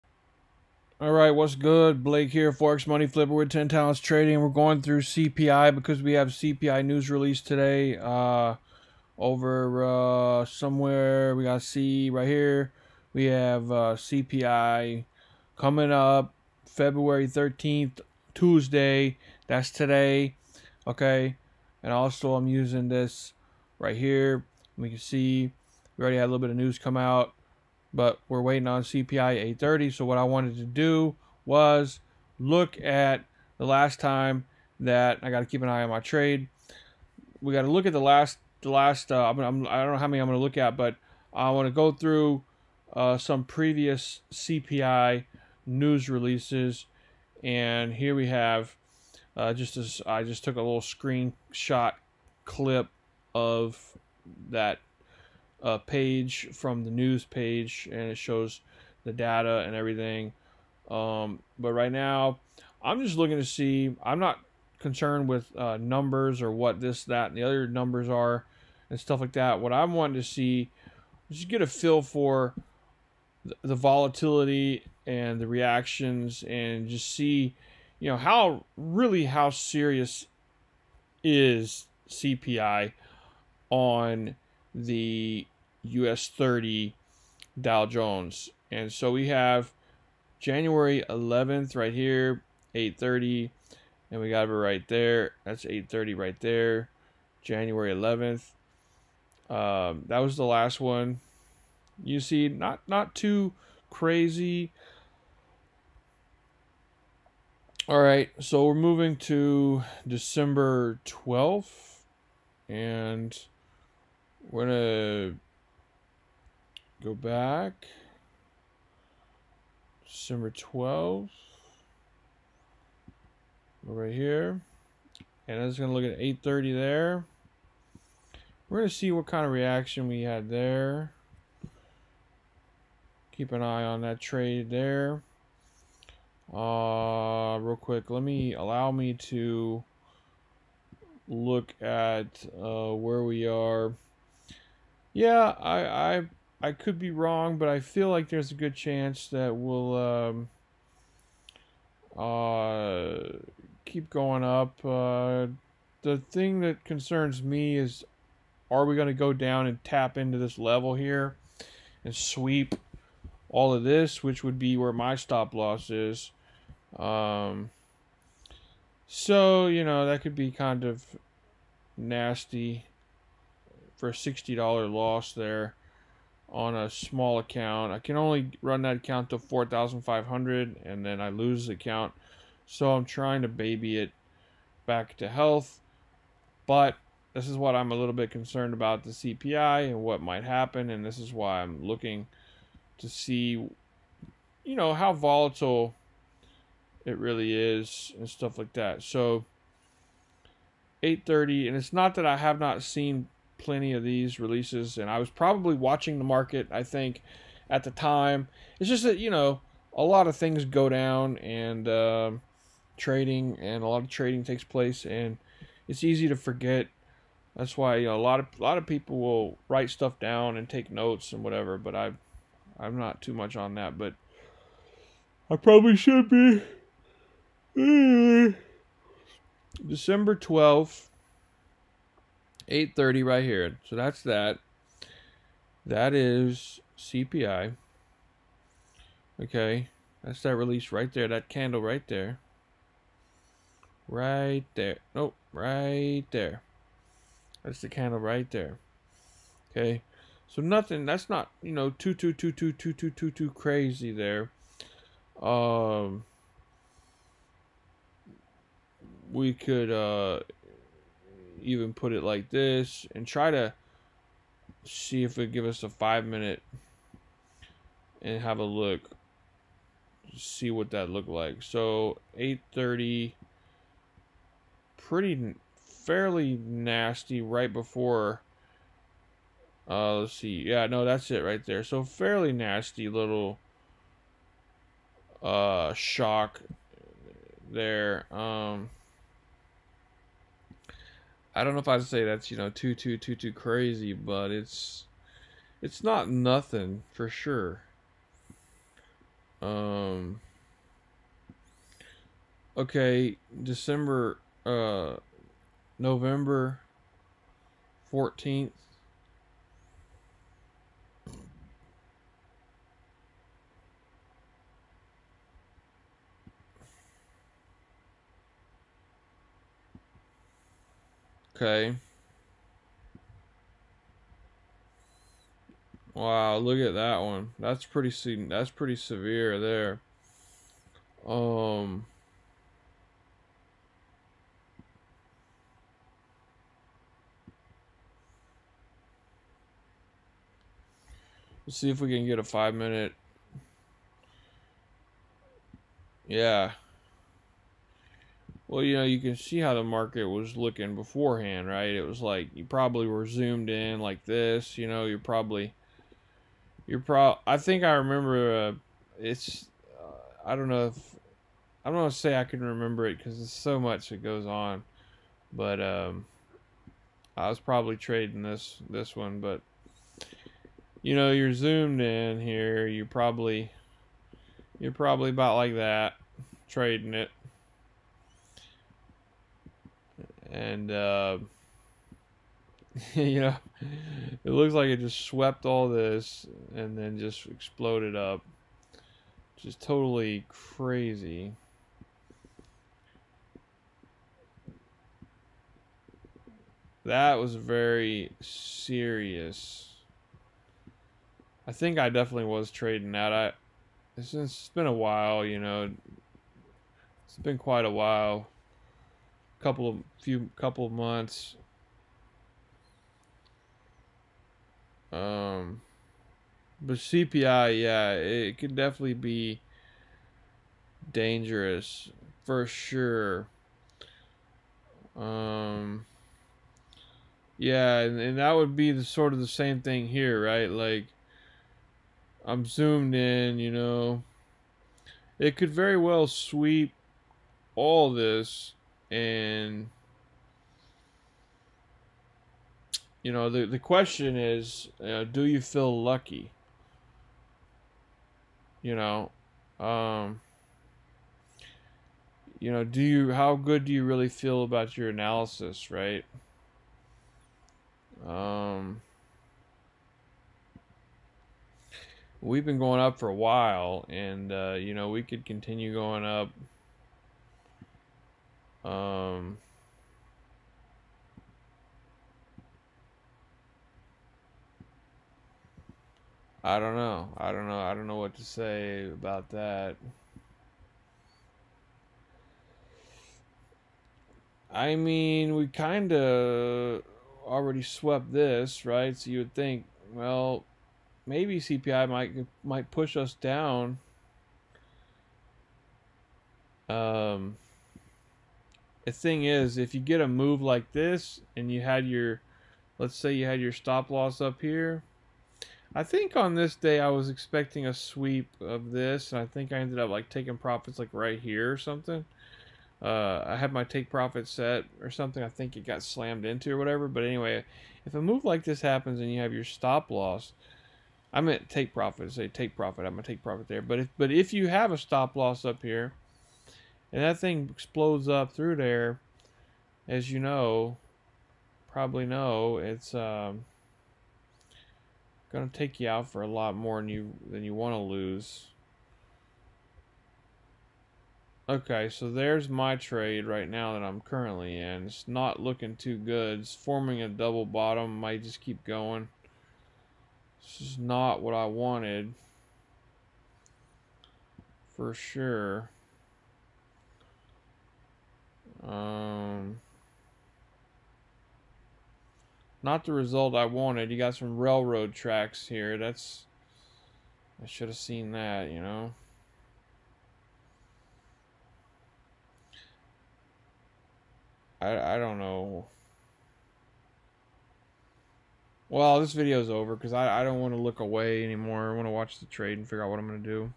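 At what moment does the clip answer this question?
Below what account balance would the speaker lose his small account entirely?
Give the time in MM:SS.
02:59.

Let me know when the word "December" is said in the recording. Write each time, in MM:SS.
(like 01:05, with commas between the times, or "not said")
01:50, 02:00, 03:49, 05:03.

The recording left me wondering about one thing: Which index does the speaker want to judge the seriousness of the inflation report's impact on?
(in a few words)
US 30 Dow Jones.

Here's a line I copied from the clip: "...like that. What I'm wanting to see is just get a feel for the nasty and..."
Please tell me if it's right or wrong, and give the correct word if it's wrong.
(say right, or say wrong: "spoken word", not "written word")
wrong: "volatility", not "nasty".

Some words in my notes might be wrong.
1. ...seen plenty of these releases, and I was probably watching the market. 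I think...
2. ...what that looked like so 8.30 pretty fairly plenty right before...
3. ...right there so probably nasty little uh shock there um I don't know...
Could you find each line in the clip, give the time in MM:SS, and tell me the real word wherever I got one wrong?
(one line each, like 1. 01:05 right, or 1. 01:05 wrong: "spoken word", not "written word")
1. 03:22 right
2. 04:30 wrong: "nasty", not "plenty"
3. 04:41 wrong: "fairly", not "probably".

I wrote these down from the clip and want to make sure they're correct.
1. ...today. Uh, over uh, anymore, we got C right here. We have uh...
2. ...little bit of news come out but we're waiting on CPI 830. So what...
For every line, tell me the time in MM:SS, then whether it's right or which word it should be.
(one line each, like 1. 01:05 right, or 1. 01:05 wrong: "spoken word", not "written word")
1. 00:07 wrong: "somewhere", not "anymore"
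2. 00:26 right.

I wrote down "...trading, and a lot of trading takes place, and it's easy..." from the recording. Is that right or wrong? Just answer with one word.
right.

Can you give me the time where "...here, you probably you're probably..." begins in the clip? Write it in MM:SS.
06:12.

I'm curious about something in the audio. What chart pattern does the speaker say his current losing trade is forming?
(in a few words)
Double bottom.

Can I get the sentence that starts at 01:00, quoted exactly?
Um, but right now, I'm just looking to see.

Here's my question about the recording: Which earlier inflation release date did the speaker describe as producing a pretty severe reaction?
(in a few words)
November 14th.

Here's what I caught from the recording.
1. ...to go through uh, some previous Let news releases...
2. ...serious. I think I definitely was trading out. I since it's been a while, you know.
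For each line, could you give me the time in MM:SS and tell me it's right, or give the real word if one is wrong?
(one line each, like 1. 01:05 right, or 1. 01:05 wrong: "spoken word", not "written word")
1. 00:41 wrong: "CPI", not "Let"
2. 06:38 right.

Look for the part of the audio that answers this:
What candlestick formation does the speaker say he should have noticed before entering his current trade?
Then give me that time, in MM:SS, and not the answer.
09:24.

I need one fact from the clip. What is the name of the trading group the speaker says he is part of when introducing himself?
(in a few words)
10 Talents Trading.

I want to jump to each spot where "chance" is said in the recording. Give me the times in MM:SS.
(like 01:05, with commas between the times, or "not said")
02:28.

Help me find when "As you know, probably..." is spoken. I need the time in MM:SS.
08:50.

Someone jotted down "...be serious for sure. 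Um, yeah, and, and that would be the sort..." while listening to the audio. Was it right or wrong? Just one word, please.
wrong.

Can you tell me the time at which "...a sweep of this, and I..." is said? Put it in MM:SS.
08:27.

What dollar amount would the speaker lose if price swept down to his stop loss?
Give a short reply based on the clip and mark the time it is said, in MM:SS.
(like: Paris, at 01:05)
$60, at 02:54.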